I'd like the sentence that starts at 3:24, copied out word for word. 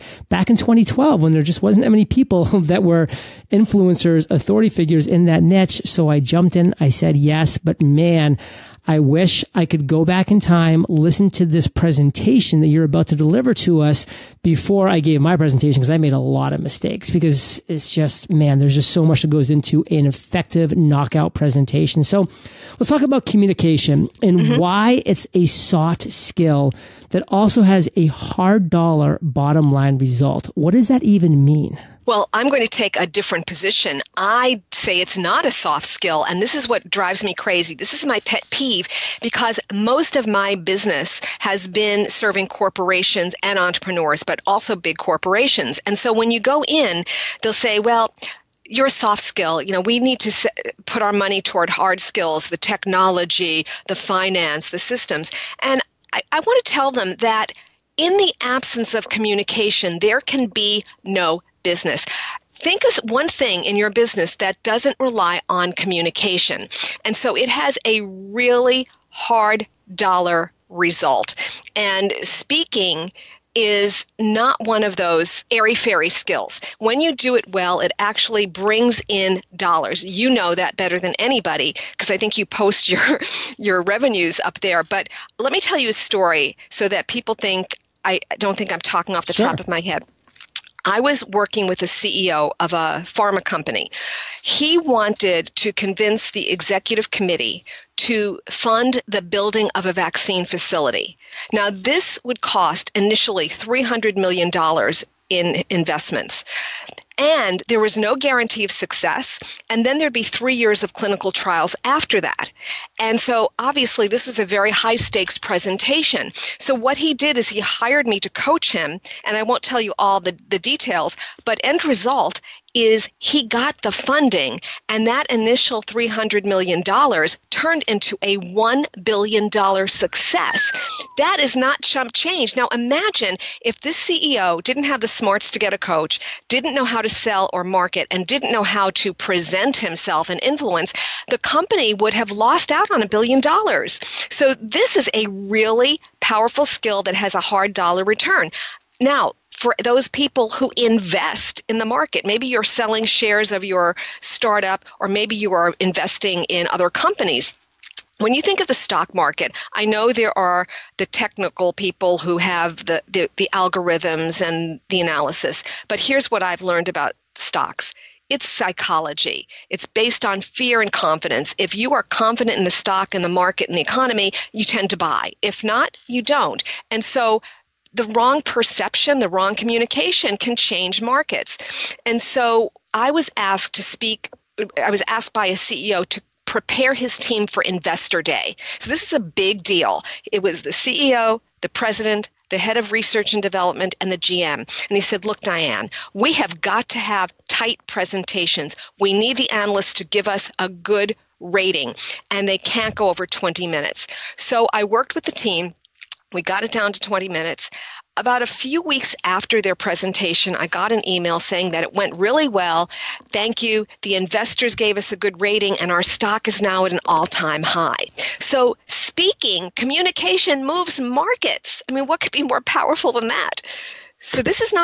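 So I worked with the team we got it down to 20 minutes.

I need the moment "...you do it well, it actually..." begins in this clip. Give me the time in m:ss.
1:17.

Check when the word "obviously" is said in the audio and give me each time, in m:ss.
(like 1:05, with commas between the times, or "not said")
1:53.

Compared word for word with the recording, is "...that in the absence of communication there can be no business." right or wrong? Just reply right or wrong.
right.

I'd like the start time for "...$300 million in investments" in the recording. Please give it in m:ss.
1:43.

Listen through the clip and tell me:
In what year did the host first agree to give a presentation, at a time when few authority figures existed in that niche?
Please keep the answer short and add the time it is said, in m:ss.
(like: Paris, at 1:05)
2012, at 0:00.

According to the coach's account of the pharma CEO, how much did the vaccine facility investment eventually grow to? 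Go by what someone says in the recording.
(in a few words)
$1 billion.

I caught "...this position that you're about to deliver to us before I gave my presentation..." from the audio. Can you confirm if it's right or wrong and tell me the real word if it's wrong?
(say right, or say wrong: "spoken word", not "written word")
wrong: "presentation", not "position".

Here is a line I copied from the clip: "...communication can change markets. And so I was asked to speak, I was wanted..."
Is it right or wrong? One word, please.
wrong.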